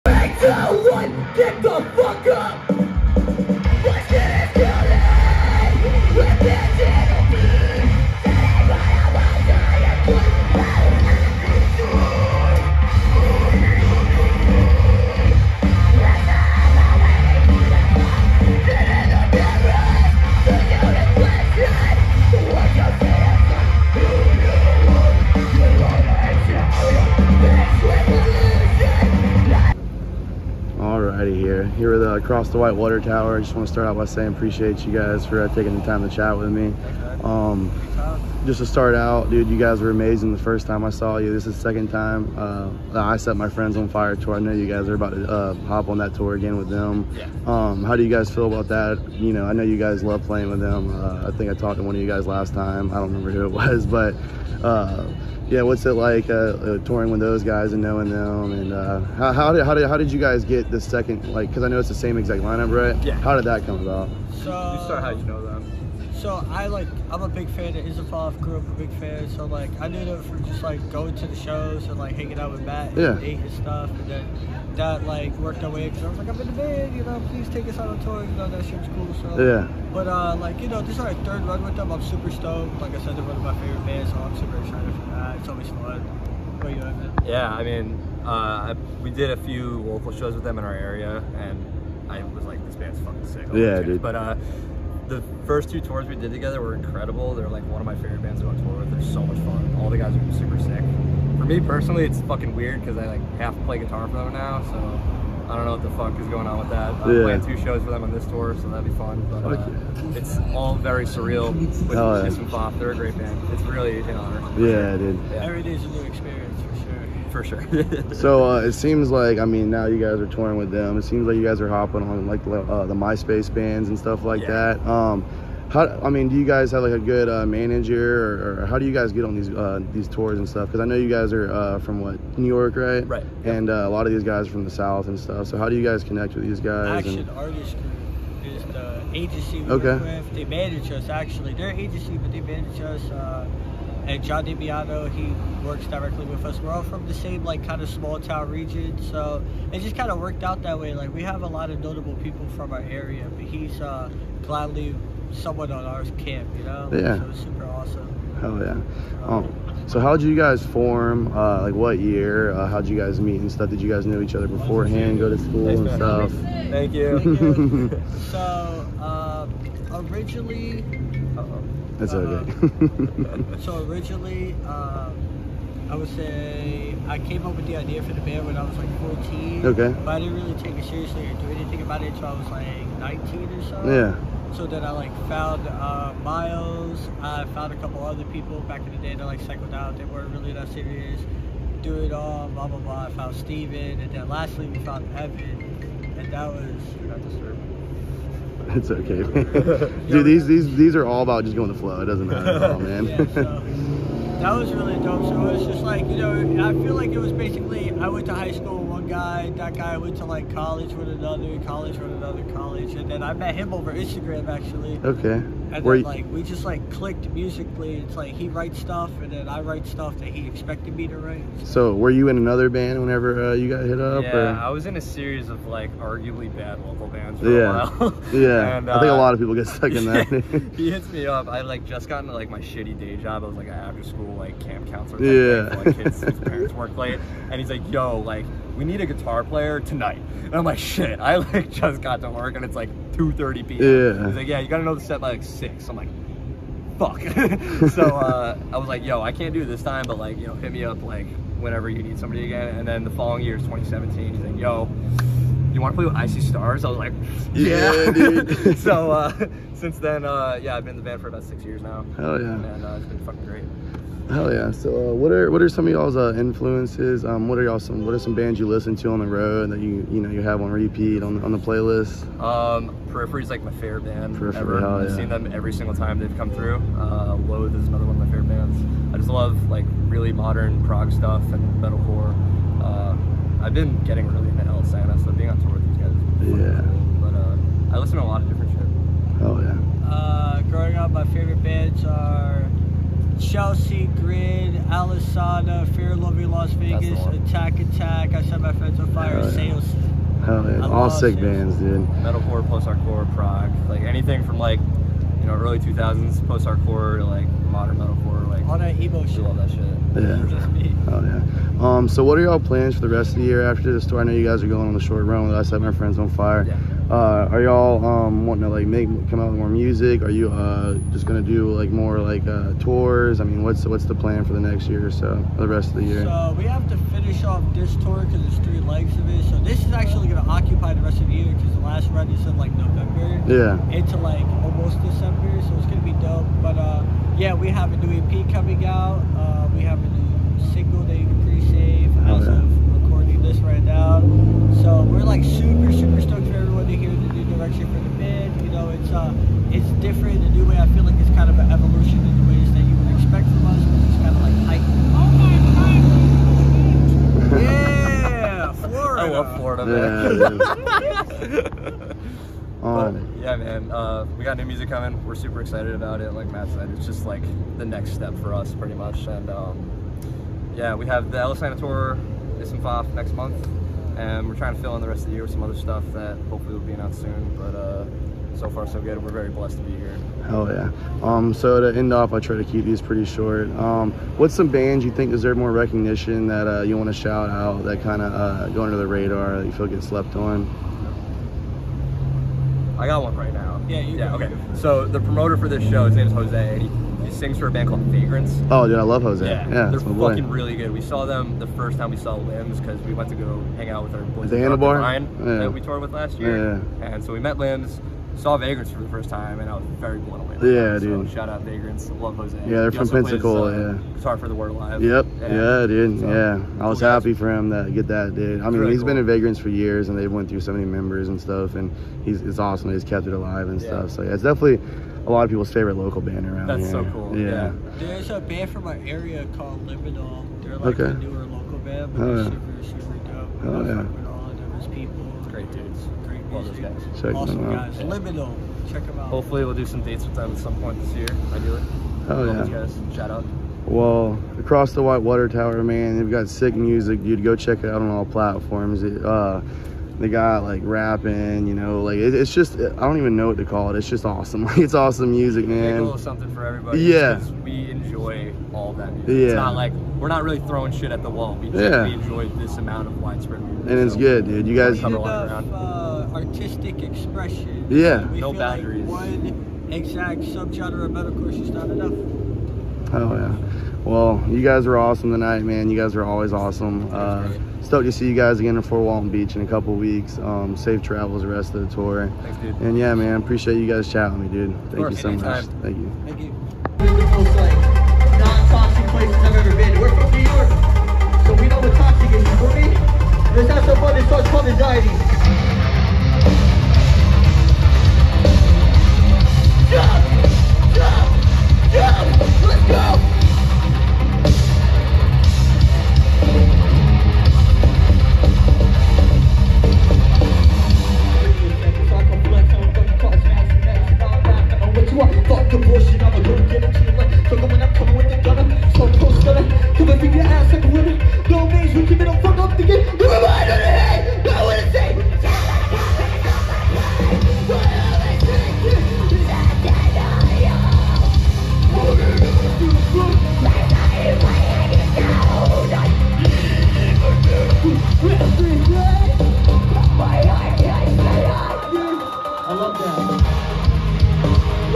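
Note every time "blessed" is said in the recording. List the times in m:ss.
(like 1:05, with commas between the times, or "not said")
6:19.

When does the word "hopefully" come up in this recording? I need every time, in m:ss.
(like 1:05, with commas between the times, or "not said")
6:16, 7:19.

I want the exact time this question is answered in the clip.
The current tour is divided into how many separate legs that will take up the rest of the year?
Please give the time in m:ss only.
5:28.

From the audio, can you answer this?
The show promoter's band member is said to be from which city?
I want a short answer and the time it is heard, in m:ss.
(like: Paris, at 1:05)
Pensacola, at 6:53.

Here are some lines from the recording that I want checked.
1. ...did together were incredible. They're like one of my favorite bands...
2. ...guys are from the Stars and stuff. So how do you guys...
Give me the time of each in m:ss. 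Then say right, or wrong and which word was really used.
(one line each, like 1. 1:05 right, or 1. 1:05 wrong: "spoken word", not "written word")
1. 1:36 right
2. 2:14 wrong: "South", not "Stars".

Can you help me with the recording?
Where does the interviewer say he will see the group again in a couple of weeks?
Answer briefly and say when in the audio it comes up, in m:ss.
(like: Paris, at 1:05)
Fort Walton Beach, at 7:58.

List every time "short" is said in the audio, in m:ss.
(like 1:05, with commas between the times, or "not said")
5:14, 6:23.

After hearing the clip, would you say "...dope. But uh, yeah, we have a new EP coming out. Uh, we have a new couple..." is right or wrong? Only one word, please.
wrong.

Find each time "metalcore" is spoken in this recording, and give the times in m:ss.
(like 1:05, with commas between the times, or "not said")
4:41, 5:02, 5:07, 7:51.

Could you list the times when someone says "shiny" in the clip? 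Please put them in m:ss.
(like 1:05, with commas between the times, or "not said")
not said.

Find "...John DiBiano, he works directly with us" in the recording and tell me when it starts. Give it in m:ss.
2:24.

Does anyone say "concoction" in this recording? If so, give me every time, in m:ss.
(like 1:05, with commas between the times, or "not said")
not said.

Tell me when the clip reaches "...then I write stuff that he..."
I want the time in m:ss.
3:39.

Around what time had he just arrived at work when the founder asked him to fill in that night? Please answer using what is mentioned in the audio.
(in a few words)
2:30 p.m.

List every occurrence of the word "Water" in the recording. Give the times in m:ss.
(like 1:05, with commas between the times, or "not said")
0:32, 7:25.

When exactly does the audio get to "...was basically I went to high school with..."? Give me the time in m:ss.
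3:27.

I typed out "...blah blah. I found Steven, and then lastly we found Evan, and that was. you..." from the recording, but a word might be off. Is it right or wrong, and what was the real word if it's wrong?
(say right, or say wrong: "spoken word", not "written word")
right.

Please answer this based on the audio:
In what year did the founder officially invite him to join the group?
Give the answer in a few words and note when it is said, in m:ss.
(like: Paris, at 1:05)
2017, at 4:13.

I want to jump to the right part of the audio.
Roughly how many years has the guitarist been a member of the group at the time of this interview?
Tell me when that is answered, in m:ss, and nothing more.
4:21.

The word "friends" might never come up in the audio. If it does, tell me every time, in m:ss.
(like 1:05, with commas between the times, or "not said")
0:43, 4:58, 5:15.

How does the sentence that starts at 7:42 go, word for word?
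we enjoy this amount of widespread music.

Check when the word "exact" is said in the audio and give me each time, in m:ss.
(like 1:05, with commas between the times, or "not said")
1:02, 7:49.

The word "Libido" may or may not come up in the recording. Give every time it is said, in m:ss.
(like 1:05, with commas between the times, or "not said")
7:18.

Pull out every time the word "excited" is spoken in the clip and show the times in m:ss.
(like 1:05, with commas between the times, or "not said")
1:24, 6:05.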